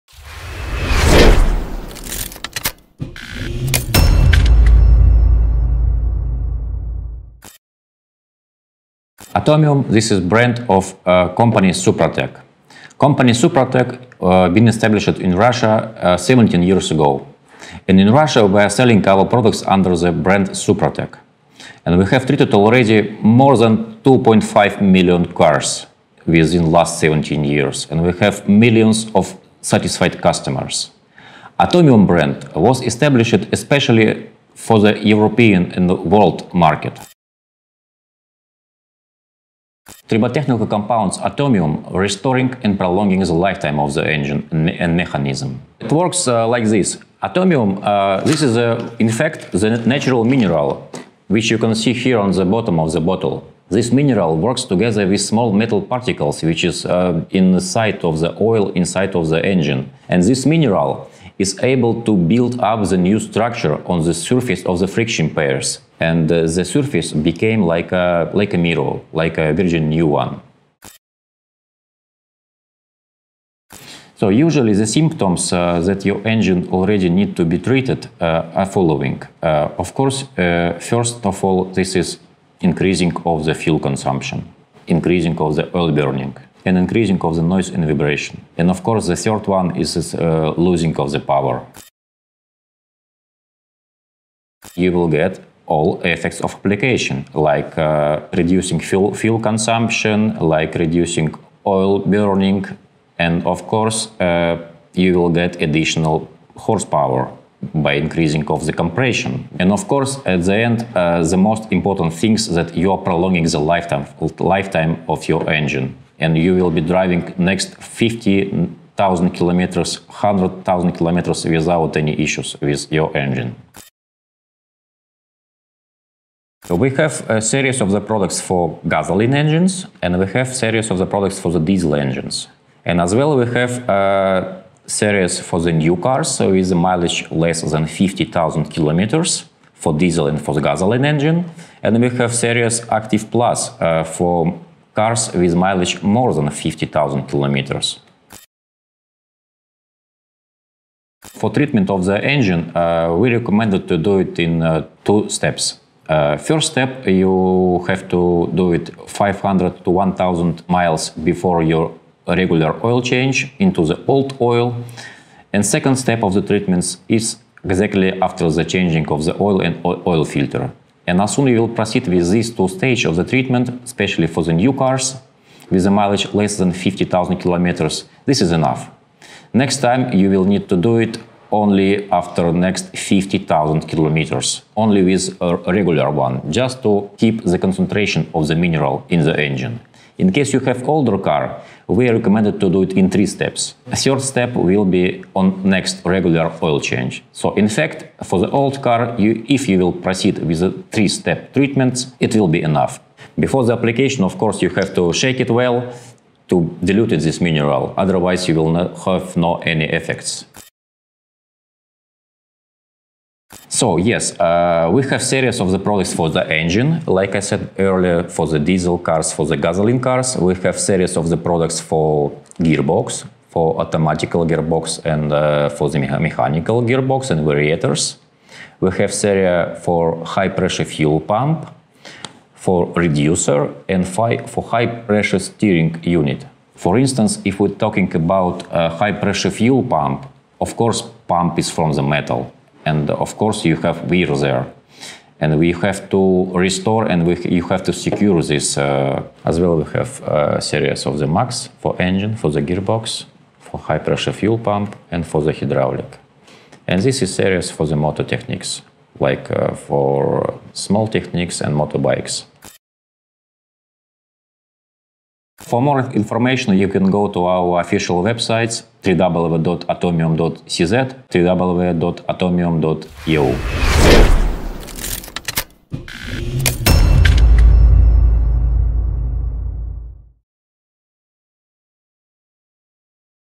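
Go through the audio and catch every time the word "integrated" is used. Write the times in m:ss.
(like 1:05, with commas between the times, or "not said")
not said.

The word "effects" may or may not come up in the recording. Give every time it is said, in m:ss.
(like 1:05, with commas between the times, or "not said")
1:36, 3:29.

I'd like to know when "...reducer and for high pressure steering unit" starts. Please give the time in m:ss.
3:52.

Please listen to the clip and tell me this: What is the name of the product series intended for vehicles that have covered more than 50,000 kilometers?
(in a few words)
Active Plus.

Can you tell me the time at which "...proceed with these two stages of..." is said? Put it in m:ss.
2:51.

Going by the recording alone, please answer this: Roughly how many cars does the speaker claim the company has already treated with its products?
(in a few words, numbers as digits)
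2.5 million.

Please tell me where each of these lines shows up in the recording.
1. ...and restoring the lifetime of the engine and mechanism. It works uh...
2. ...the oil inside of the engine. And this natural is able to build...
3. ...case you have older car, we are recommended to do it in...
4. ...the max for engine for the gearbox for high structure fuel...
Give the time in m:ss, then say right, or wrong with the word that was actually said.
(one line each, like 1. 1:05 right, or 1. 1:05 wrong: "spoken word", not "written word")
1. 0:42 wrong: "prolonging", not "restoring"
2. 0:58 wrong: "mineral", not "natural"
3. 3:10 right
4. 4:11 wrong: "pressure", not "structure".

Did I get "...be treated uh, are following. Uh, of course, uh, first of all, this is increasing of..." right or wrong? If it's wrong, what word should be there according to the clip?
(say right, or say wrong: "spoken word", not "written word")
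right.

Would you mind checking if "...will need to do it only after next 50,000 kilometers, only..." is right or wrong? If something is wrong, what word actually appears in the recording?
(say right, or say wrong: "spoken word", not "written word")
right.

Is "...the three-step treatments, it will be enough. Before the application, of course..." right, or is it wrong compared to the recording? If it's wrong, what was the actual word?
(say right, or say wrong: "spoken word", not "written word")
right.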